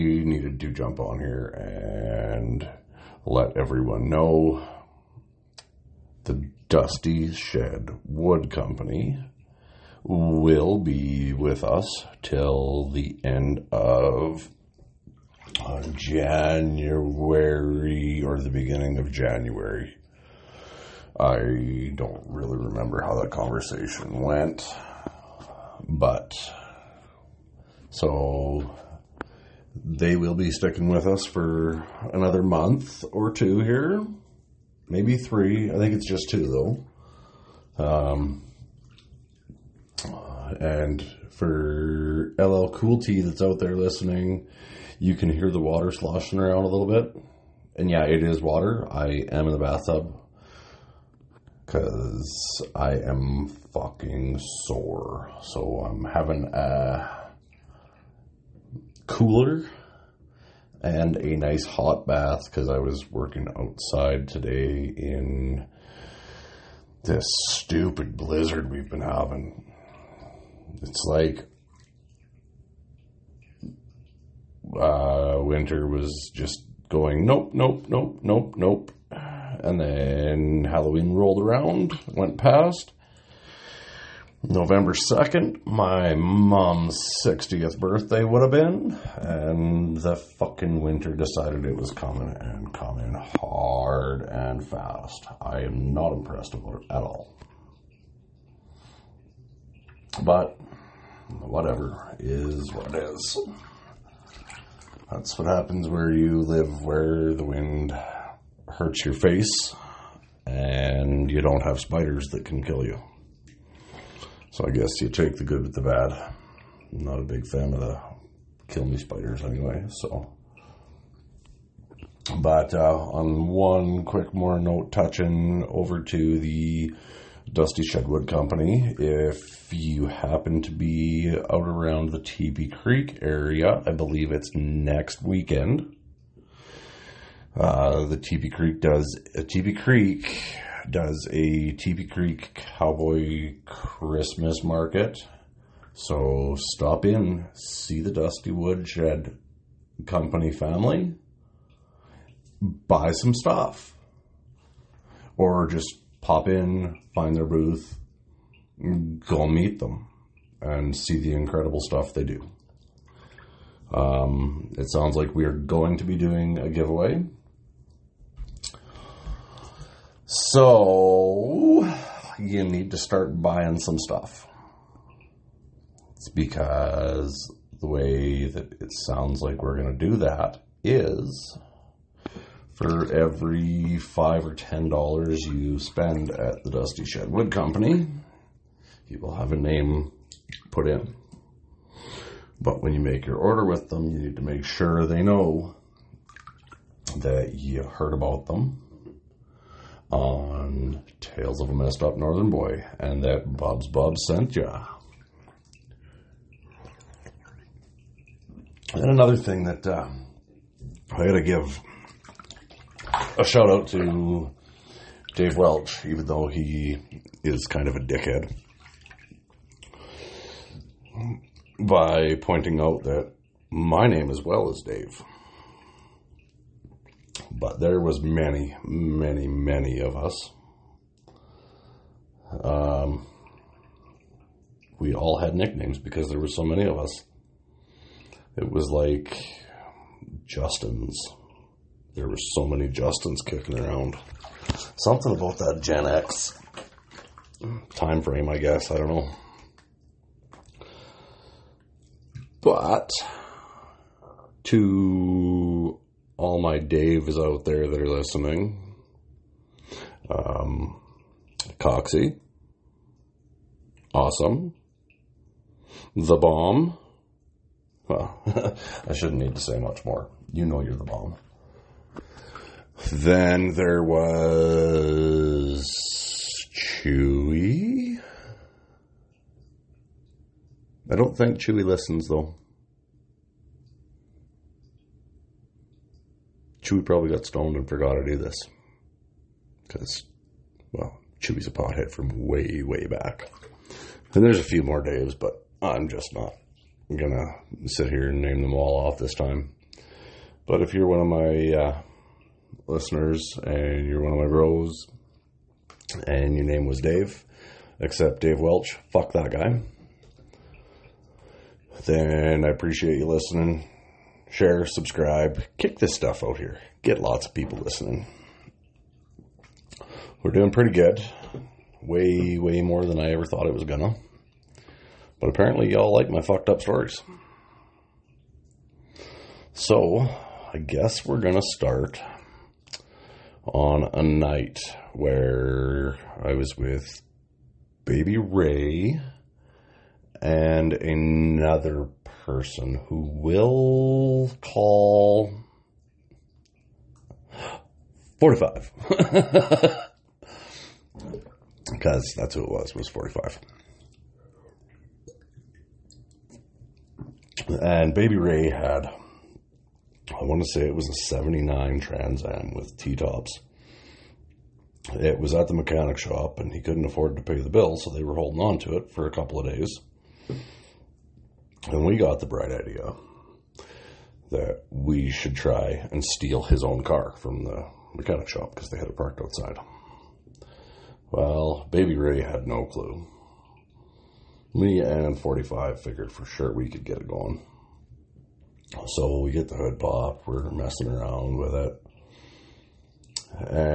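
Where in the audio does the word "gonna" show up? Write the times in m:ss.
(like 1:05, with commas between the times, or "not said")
4:57, 5:23, 5:31.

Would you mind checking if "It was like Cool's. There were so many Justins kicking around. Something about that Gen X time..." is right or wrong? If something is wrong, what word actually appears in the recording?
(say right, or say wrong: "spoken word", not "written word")
wrong: "Justin", not "Cool".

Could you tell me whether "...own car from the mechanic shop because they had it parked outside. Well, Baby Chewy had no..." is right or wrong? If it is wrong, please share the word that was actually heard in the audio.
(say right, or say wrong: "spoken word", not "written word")
wrong: "Ray", not "Chewy".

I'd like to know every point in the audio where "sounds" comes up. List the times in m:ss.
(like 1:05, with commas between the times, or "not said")
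2:44, 2:59.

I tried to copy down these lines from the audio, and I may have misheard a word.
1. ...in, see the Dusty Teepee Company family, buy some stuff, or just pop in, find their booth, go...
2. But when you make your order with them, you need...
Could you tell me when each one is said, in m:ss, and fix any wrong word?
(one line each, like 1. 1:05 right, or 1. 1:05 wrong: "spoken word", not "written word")
1. 2:27 wrong: "Woodshed", not "Teepee"
2. 3:12 right.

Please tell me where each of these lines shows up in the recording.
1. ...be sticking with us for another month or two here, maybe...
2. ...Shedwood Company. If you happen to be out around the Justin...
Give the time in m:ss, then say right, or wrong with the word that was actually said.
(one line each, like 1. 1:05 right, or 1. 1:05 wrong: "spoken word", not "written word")
1. 0:30 right
2. 2:07 wrong: "Teepee", not "Justin".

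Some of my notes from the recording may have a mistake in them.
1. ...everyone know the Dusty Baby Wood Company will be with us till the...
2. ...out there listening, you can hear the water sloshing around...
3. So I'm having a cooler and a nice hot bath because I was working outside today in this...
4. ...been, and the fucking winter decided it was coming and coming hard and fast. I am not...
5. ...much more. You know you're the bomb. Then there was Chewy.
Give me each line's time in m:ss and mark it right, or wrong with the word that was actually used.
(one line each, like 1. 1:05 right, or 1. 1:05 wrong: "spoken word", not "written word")
1. 0:03 wrong: "Shed", not "Baby"
2. 0:43 right
3. 0:55 right
4. 1:28 right
5. 4:29 right.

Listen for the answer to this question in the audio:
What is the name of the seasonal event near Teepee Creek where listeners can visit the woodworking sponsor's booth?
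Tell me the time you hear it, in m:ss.
2:22.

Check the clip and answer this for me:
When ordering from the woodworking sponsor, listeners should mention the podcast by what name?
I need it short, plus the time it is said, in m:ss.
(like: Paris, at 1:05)
Tales of a Messed Up Northern Boy, at 3:21.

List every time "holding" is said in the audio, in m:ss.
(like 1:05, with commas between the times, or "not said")
6:08.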